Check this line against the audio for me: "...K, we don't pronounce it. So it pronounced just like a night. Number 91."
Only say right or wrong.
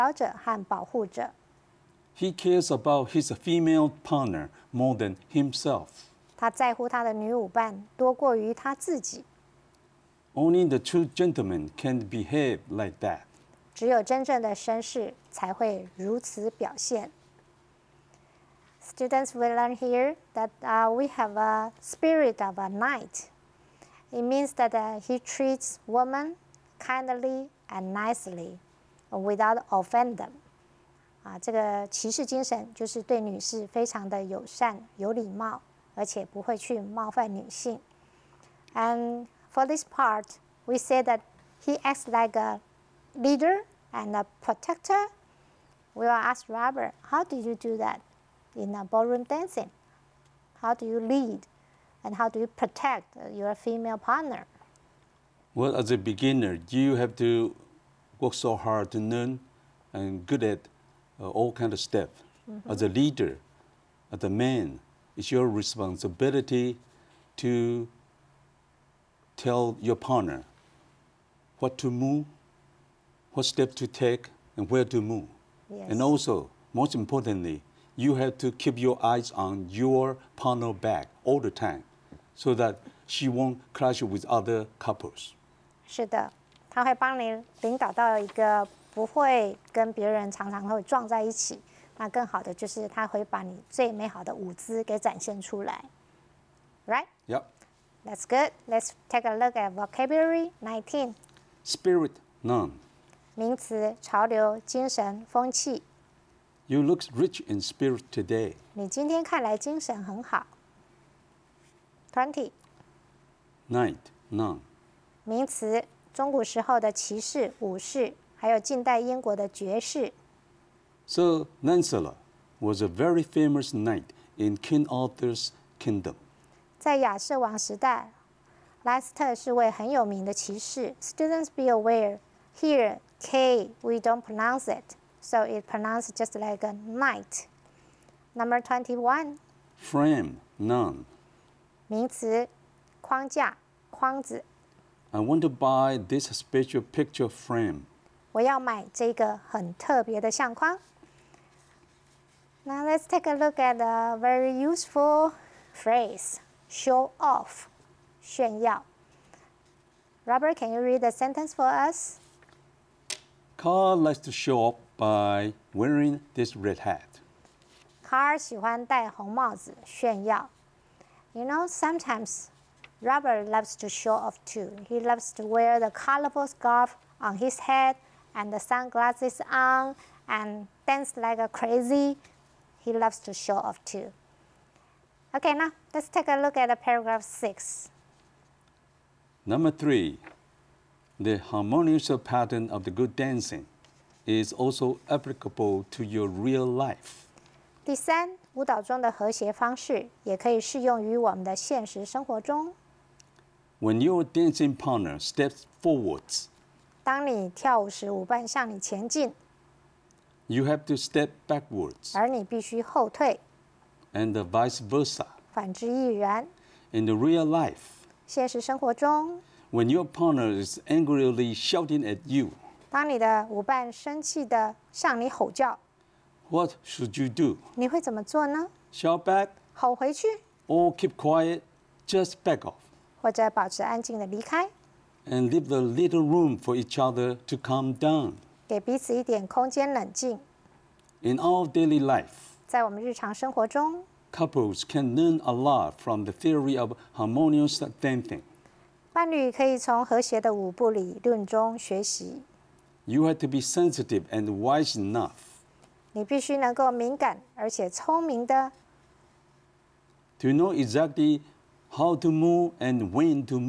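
wrong.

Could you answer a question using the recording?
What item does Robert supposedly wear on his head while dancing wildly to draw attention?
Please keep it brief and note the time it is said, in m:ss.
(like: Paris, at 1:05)
colorful scarf, at 2:55.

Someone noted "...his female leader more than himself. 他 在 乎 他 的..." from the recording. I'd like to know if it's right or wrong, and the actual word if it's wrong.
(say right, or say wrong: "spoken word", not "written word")
wrong: "partner", not "leader".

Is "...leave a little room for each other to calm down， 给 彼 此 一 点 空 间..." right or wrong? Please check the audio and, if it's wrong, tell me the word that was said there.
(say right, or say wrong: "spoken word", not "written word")
right.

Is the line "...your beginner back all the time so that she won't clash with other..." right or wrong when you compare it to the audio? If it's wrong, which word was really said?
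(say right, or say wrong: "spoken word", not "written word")
wrong: "partner", not "beginner".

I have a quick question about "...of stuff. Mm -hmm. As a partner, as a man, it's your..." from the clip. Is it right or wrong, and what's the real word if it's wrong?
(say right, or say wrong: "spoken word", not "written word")
wrong: "leader", not "partner".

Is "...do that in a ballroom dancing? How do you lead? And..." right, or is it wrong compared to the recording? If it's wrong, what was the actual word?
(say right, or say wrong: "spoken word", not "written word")
right.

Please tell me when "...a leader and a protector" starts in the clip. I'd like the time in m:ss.
0:42.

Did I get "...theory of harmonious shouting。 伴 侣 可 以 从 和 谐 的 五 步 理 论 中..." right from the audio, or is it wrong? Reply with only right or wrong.
wrong.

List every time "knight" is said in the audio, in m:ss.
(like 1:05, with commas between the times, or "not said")
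0:22, 1:53, 2:03.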